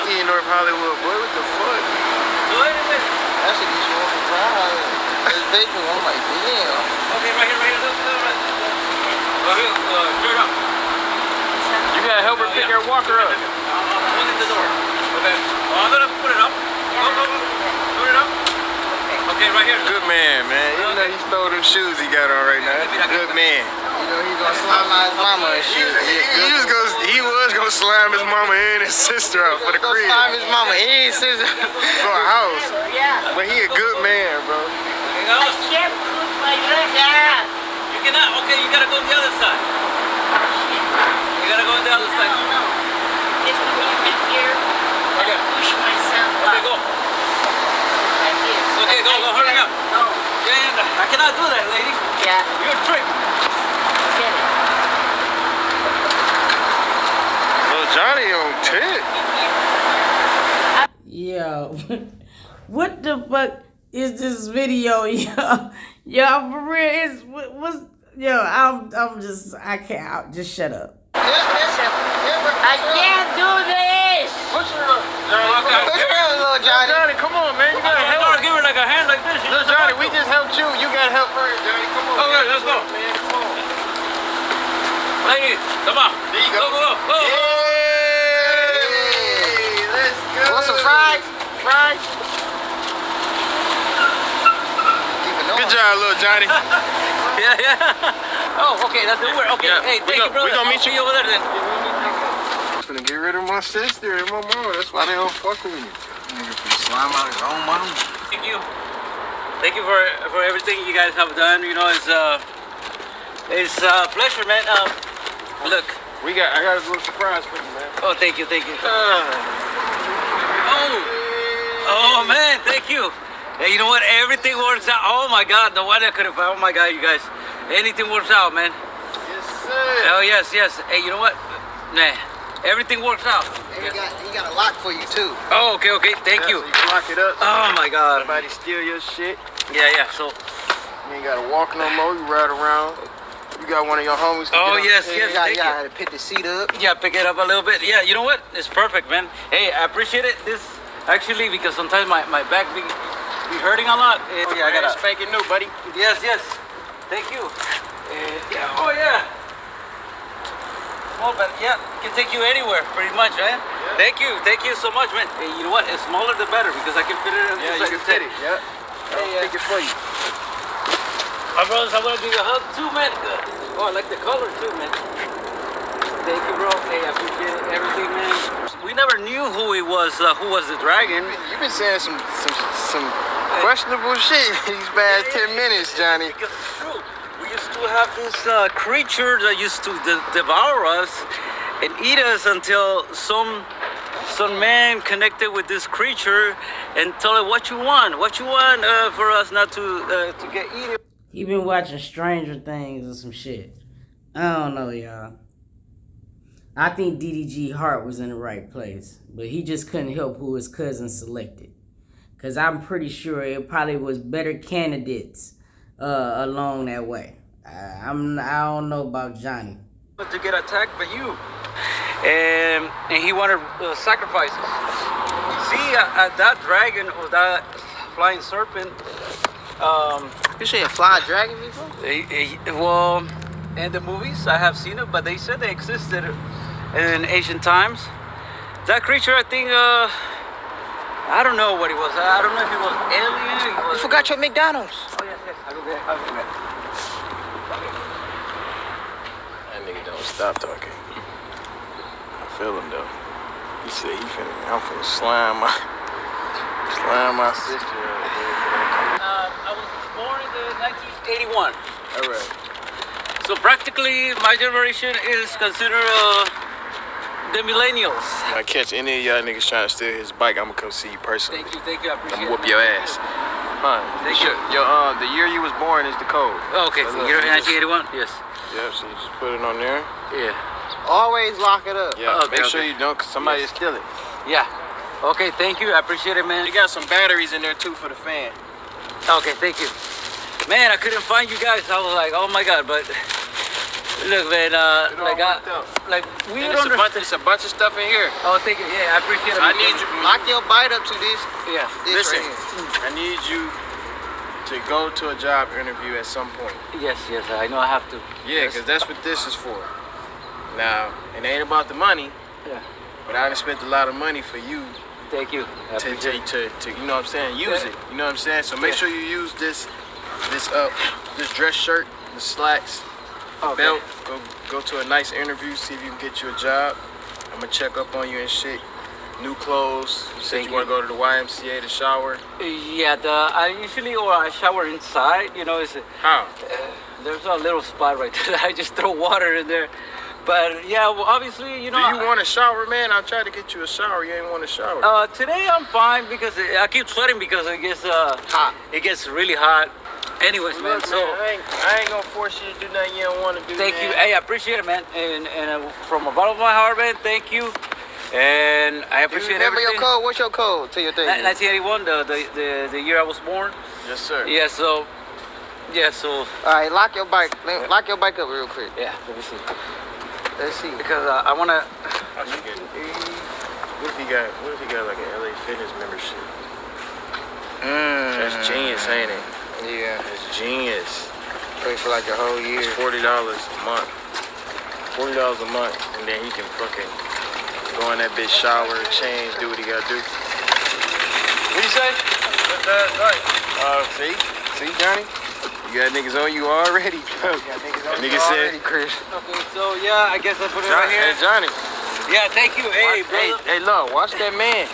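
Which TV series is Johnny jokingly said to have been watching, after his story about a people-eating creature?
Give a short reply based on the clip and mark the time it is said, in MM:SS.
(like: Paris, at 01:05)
Stranger Things, at 03:21.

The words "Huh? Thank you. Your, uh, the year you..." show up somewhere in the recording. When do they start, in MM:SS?
04:33.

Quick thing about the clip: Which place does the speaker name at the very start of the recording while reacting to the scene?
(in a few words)
North Hollywood.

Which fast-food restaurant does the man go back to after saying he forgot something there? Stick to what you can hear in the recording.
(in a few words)
McDonald's.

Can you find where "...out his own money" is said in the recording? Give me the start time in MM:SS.
01:47.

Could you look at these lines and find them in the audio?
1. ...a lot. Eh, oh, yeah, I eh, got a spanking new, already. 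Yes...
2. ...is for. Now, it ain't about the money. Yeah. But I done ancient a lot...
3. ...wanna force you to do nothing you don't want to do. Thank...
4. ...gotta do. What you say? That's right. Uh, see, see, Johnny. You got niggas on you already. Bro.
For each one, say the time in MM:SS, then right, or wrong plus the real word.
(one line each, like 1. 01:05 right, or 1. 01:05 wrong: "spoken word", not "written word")
1. 02:33 wrong: "buddy", not "already"
2. 05:09 wrong: "spent", not "ancient"
3. 05:52 wrong: "gonna", not "wanna"
4. 06:29 right.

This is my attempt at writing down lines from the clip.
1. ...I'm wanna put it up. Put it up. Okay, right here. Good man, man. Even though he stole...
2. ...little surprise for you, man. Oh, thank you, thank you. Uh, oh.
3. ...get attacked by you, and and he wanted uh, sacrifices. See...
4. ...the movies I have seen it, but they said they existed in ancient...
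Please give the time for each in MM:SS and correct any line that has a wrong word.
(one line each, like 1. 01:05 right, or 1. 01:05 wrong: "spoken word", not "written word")
1. 00:15 wrong: "gonna", not "wanna"
2. 01:56 right
3. 03:40 right
4. 03:53 right.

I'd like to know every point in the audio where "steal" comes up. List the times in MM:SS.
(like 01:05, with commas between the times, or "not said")
02:18, 04:29, 04:43.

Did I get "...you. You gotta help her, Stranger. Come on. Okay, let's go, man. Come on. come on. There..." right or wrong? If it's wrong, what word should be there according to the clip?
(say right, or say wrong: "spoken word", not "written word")
wrong: "Johnny", not "Stranger".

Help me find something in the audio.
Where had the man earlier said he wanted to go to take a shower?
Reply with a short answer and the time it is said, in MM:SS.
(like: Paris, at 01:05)
YMCA, at 05:31.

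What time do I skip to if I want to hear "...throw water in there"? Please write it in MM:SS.
05:38.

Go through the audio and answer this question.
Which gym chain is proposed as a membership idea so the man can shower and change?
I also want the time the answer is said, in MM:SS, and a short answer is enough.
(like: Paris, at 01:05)
LA Fitness, at 06:15.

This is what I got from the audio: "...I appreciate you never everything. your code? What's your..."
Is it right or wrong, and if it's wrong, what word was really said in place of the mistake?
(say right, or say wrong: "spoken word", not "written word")
wrong: "remember", not "never".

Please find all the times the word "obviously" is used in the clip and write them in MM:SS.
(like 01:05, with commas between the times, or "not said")
05:41.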